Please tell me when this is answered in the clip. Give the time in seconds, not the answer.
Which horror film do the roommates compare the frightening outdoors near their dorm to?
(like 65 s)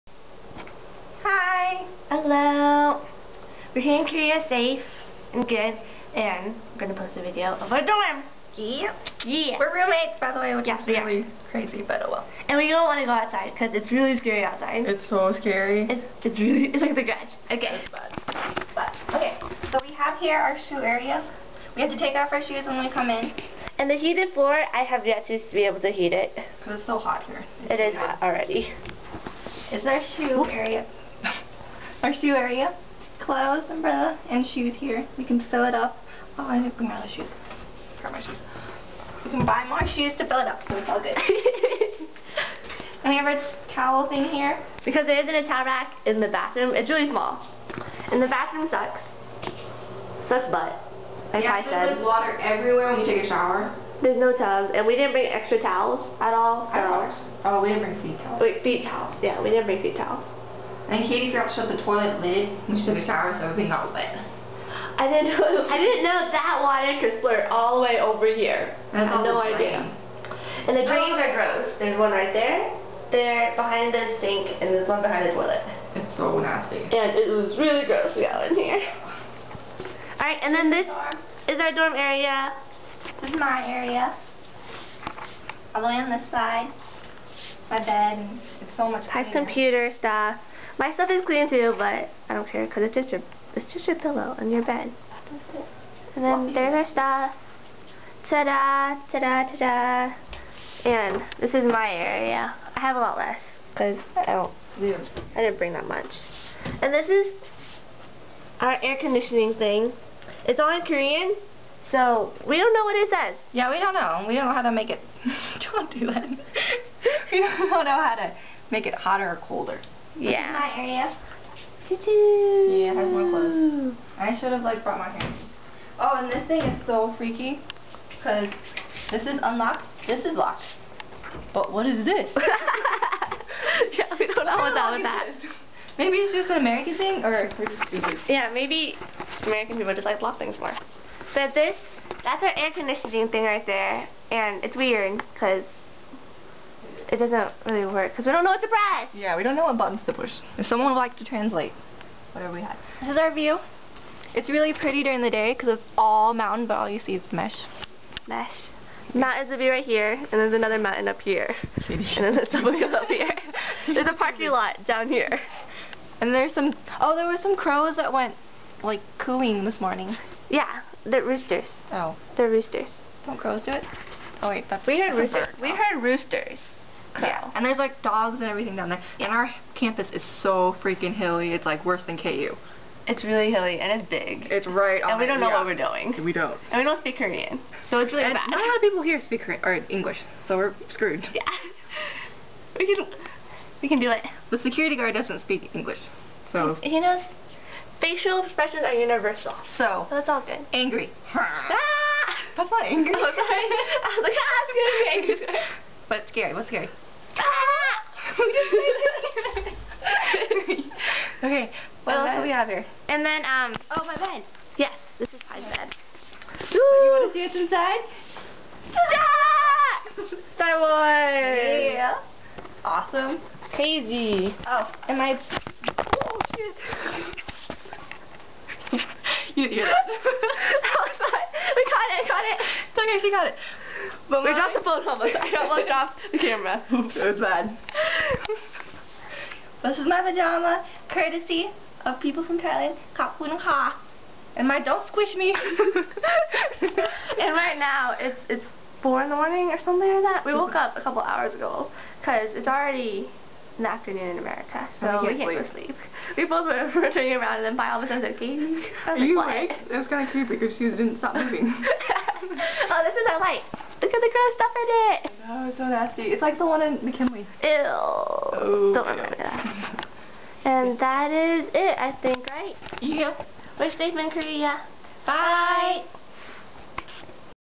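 16 s.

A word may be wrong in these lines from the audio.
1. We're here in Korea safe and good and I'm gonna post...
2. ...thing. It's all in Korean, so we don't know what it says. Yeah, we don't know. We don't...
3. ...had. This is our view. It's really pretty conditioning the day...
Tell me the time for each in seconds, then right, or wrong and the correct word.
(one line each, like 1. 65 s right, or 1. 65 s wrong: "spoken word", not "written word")
1. 3 s right
2. 109 s right
3. 152 s wrong: "during", not "conditioning".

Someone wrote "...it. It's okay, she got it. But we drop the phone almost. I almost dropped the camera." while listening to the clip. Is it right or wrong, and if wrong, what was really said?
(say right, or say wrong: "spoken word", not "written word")
right.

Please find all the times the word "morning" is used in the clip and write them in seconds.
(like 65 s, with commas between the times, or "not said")
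169 s, 249 s.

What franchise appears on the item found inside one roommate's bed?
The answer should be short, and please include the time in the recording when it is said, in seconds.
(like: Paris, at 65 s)
Star Wars, at 220 s.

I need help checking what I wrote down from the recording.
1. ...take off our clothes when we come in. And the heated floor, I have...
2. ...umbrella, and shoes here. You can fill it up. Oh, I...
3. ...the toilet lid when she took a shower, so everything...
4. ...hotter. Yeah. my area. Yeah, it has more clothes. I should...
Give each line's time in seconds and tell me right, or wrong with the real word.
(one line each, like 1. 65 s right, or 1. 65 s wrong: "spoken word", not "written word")
1. 21 s wrong: "shoes", not "clothes"
2. 33 s right
3. 61 s right
4. 119 s wrong: "colder", not "hotter".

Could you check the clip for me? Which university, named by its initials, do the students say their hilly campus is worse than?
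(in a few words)
KU.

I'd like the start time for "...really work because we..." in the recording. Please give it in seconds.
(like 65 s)
147 s.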